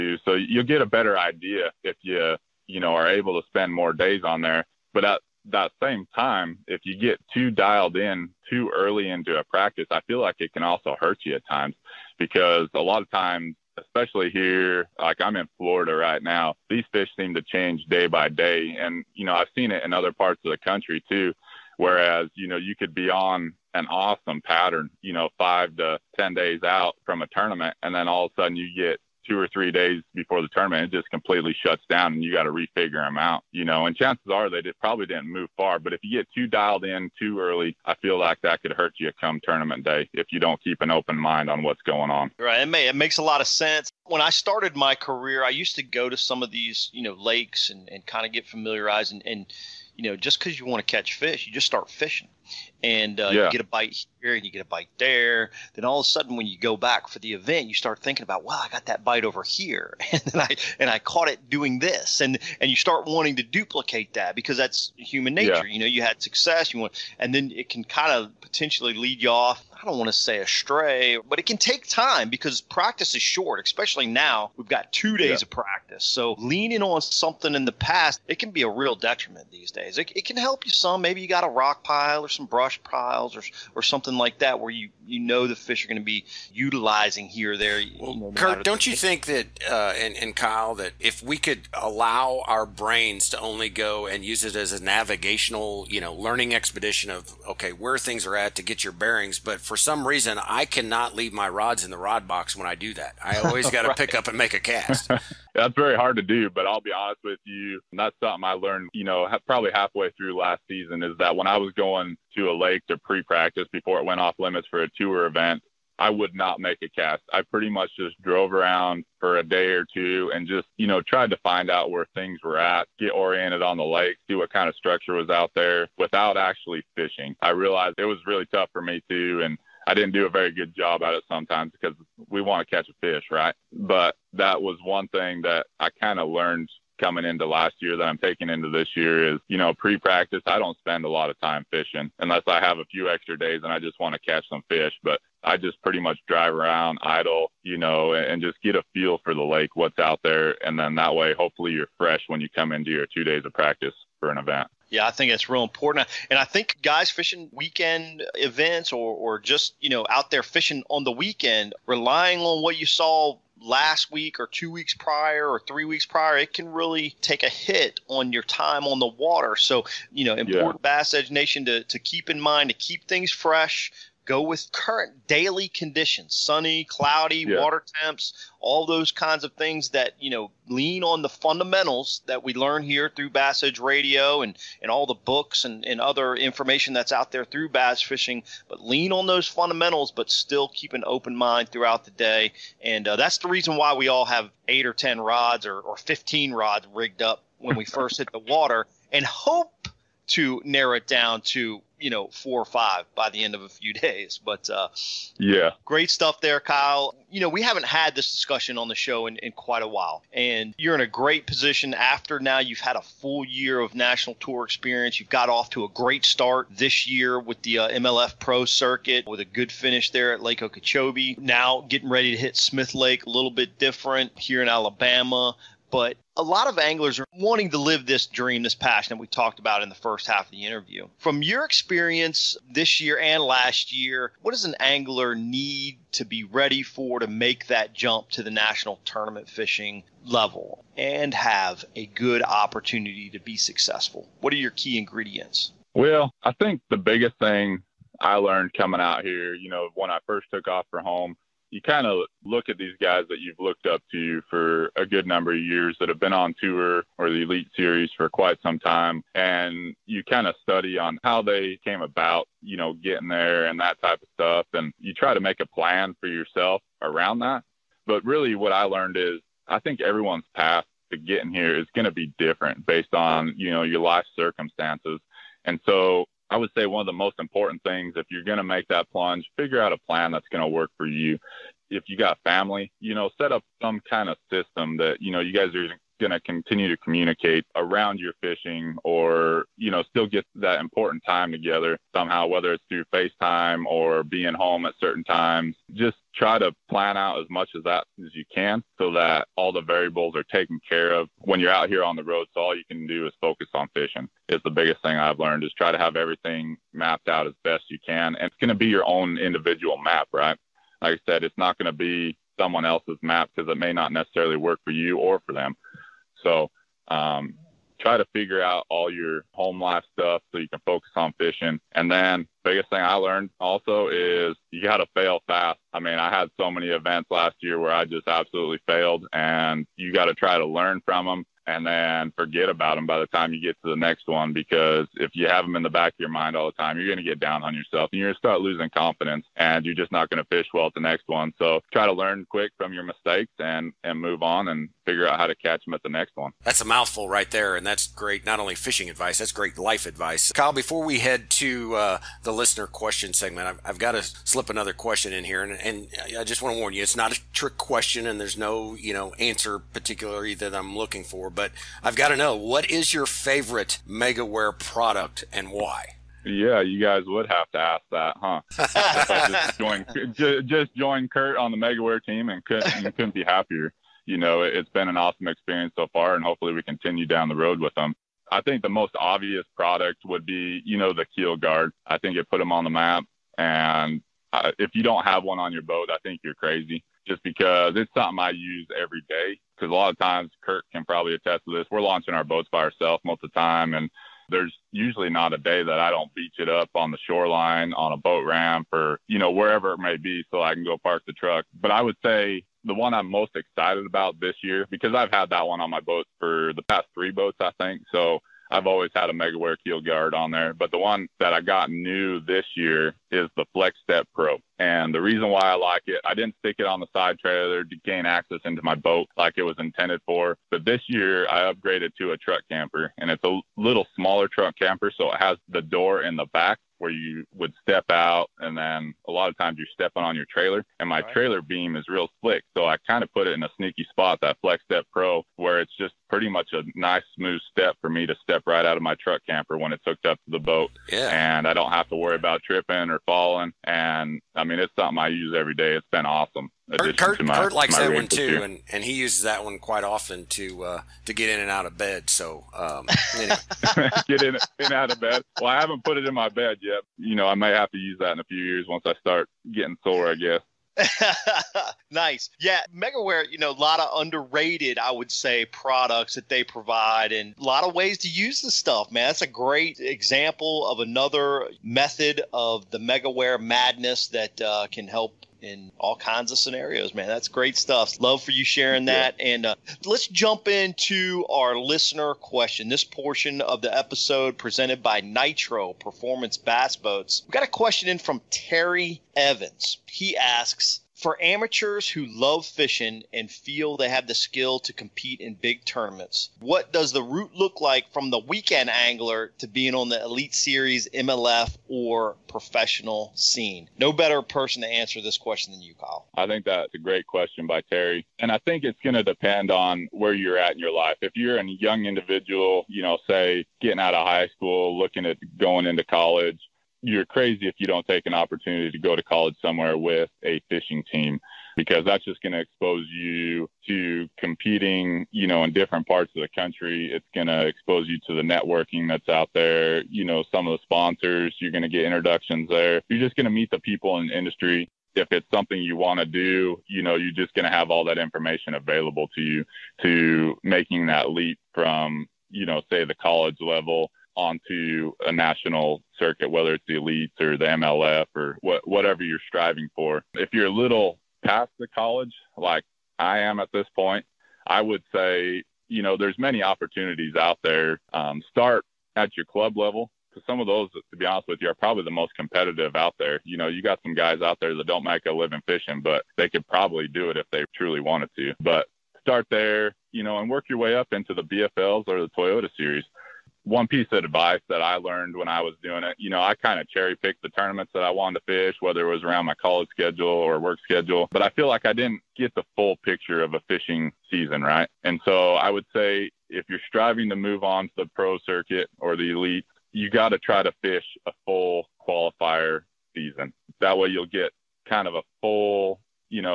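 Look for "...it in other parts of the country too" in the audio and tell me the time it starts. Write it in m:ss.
0:19.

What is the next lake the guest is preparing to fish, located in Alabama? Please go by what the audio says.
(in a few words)
Smith Lake.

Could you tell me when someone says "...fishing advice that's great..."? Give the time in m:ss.
5:48.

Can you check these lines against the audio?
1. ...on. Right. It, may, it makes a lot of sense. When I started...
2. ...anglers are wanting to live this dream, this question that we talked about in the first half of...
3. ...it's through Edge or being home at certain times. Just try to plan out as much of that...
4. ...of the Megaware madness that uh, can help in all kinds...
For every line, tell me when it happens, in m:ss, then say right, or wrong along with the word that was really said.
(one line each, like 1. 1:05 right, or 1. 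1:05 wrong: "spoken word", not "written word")
1. 0:42 right
2. 3:46 wrong: "passion", not "question"
3. 4:52 wrong: "FaceTime", not "Edge"
4. 7:52 right.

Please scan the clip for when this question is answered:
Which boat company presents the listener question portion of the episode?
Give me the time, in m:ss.
8:05.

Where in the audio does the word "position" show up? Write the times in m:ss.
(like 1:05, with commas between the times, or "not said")
3:31.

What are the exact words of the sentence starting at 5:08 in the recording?
And it's going to be your own individual map, right?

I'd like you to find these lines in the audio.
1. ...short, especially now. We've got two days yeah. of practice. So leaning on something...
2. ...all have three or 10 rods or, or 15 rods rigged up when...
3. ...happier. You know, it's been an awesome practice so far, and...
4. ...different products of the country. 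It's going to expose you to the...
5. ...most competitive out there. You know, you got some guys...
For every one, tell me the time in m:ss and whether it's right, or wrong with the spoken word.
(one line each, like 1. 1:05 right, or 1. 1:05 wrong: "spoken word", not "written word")
1. 1:13 right
2. 3:14 wrong: "eight", not "three"
3. 6:13 wrong: "experience", not "practice"
4. 8:45 wrong: "parts", not "products"
5. 9:22 right.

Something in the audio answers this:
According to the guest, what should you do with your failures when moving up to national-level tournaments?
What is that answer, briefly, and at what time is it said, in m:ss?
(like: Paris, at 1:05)
fail fast, at 5:25.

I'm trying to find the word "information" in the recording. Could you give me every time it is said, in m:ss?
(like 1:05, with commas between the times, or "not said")
3:06, 8:58.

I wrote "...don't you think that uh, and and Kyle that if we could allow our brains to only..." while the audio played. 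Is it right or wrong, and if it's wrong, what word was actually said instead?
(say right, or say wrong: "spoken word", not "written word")
right.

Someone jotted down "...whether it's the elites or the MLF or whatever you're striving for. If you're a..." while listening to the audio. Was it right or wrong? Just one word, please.
right.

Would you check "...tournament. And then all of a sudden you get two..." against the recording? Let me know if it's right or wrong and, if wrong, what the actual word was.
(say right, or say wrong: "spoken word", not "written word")
right.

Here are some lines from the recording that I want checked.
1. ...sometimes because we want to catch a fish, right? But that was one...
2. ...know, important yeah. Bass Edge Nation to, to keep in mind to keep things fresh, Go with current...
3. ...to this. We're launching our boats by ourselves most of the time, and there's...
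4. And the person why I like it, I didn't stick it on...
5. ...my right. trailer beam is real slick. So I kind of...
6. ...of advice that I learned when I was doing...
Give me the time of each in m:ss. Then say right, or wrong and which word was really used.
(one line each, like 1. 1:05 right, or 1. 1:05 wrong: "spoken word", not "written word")
1. 2:11 right
2. 2:50 right
3. 6:31 right
4. 6:54 wrong: "reason", not "person"
5. 7:11 right
6. 9:34 right.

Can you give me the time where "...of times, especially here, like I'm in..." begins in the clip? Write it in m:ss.
0:13.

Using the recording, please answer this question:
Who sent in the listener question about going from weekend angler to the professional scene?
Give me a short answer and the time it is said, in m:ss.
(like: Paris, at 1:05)
Terry Evans, at 8:08.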